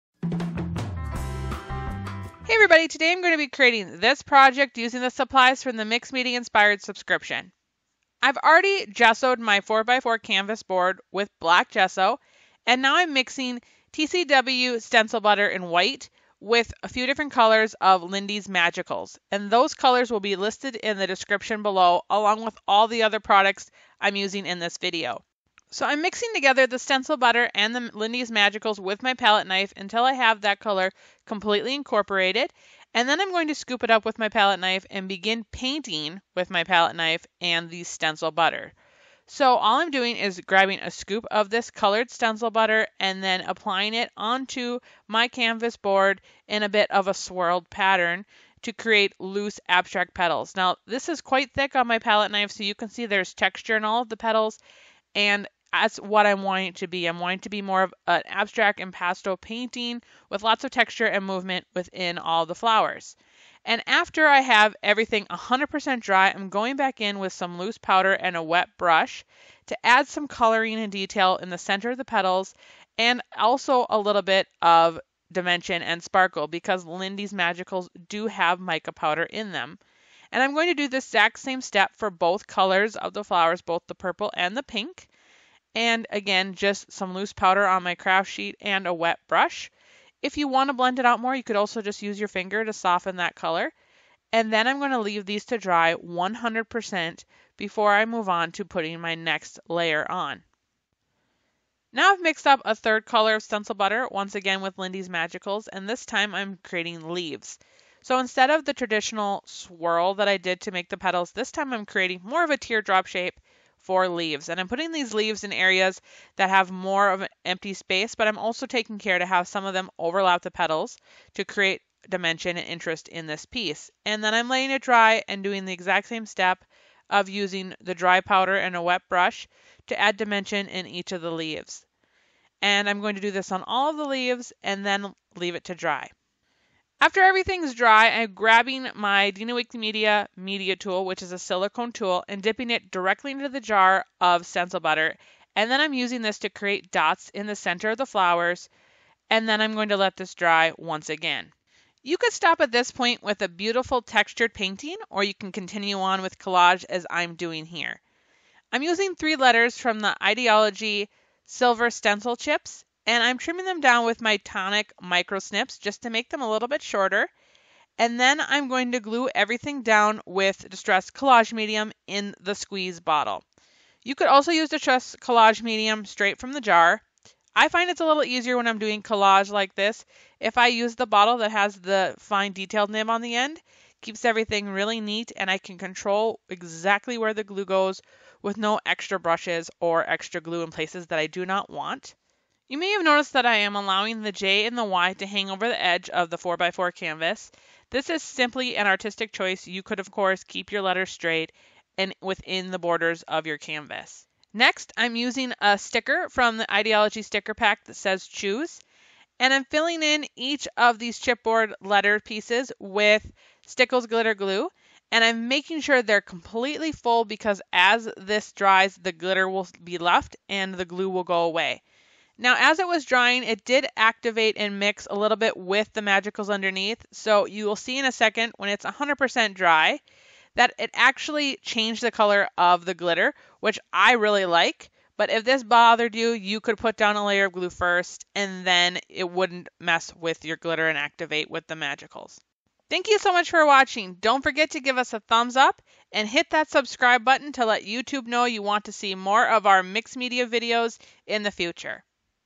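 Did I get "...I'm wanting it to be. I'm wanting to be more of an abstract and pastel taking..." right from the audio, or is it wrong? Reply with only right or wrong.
wrong.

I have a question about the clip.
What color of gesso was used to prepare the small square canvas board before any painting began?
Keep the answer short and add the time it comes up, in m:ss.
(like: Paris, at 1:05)
black, at 0:11.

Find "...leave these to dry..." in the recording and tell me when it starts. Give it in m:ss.
1:34.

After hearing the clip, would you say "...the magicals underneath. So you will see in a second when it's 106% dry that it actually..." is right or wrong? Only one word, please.
wrong.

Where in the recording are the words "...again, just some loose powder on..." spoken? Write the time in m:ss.
1:26.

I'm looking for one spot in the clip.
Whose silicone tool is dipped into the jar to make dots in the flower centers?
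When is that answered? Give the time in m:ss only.
2:19.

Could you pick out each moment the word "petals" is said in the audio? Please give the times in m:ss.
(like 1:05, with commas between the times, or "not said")
0:50, 0:54, 1:12, 1:50, 2:00.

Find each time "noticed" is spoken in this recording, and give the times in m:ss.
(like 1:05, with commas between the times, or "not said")
3:13.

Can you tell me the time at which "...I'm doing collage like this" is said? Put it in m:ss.
2:58.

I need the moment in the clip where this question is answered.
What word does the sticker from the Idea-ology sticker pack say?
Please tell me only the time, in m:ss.
3:28.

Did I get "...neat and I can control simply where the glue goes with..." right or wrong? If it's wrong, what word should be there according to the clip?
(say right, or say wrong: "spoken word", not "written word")
wrong: "exactly", not "simply".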